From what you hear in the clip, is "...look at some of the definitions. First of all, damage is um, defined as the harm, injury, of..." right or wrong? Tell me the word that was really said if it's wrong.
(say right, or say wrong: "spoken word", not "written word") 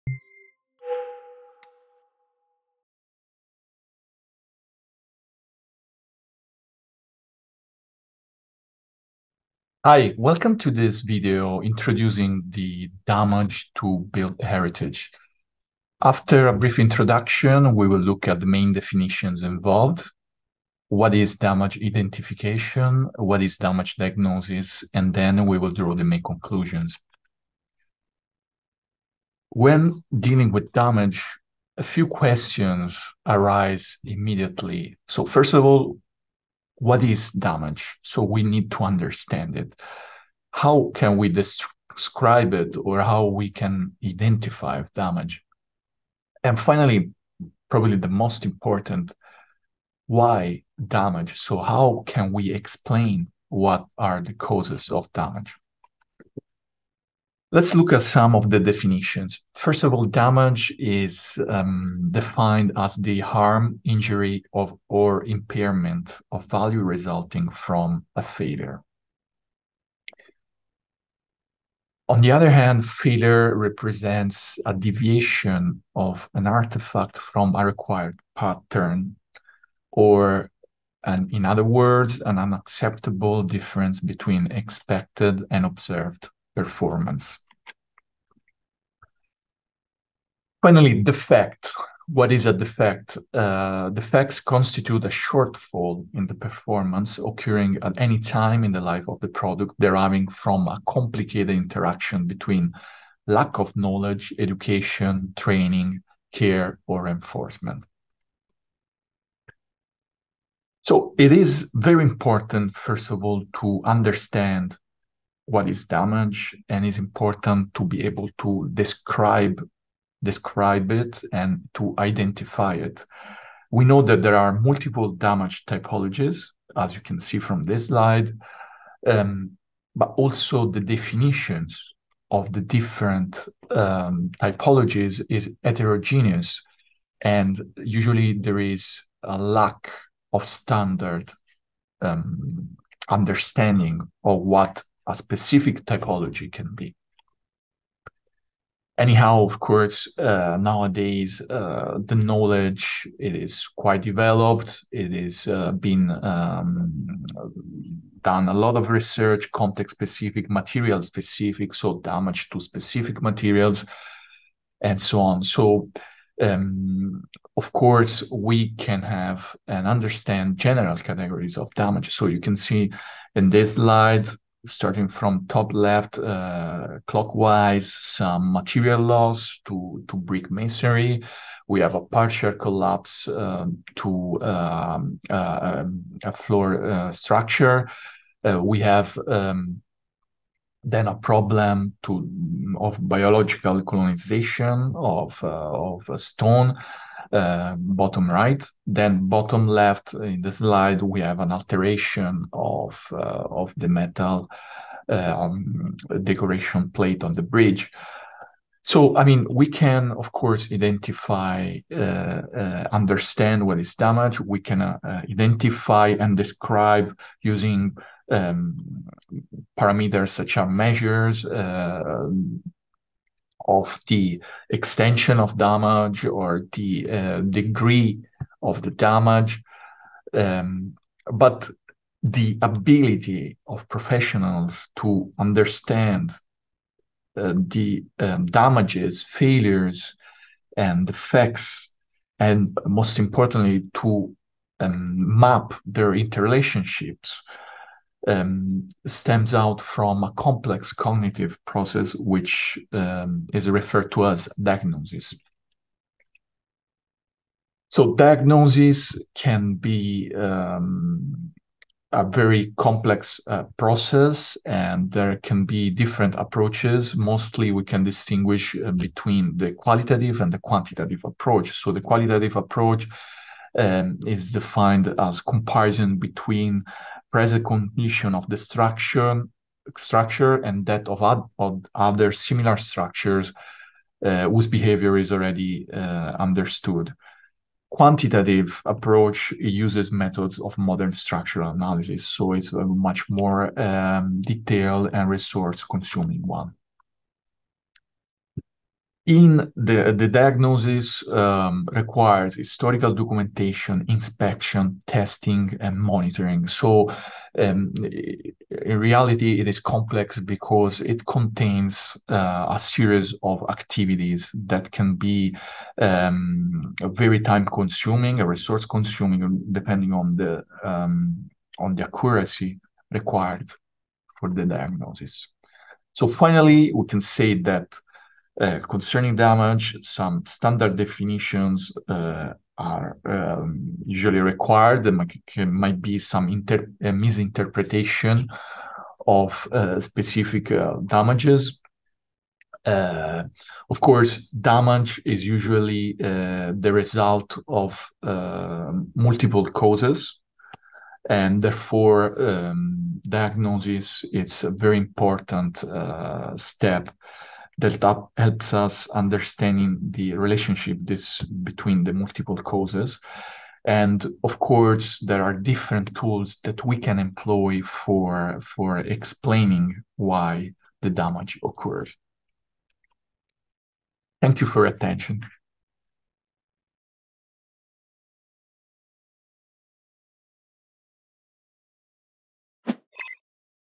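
right.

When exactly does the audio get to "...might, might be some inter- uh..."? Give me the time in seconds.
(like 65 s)
335 s.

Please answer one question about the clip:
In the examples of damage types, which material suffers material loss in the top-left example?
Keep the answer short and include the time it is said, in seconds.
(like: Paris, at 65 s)
Brick masonry, at 180 s.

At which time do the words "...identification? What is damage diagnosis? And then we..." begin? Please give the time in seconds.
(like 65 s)
21 s.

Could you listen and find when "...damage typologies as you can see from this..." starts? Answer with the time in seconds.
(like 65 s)
125 s.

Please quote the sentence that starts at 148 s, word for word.
Anyhow, of course, uh, nowadays uh, the knowledge it is quite developed.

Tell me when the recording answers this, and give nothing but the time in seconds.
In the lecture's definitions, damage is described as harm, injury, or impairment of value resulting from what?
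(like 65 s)
68 s.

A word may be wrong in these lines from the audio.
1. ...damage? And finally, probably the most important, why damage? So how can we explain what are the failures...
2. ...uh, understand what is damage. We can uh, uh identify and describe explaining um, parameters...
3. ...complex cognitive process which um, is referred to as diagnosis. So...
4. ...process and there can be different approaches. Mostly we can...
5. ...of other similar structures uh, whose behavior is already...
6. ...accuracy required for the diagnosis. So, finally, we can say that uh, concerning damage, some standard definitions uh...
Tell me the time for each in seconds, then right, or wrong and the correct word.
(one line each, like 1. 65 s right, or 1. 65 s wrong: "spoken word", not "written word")
1. 44 s wrong: "causes", not "failures"
2. 211 s wrong: "using", not "explaining"
3. 250 s right
4. 263 s right
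5. 281 s right
6. 322 s right.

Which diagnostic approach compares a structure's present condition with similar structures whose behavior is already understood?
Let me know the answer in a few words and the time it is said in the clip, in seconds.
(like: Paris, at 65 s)
Qualitative approach, at 272 s.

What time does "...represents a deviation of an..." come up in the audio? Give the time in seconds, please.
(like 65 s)
73 s.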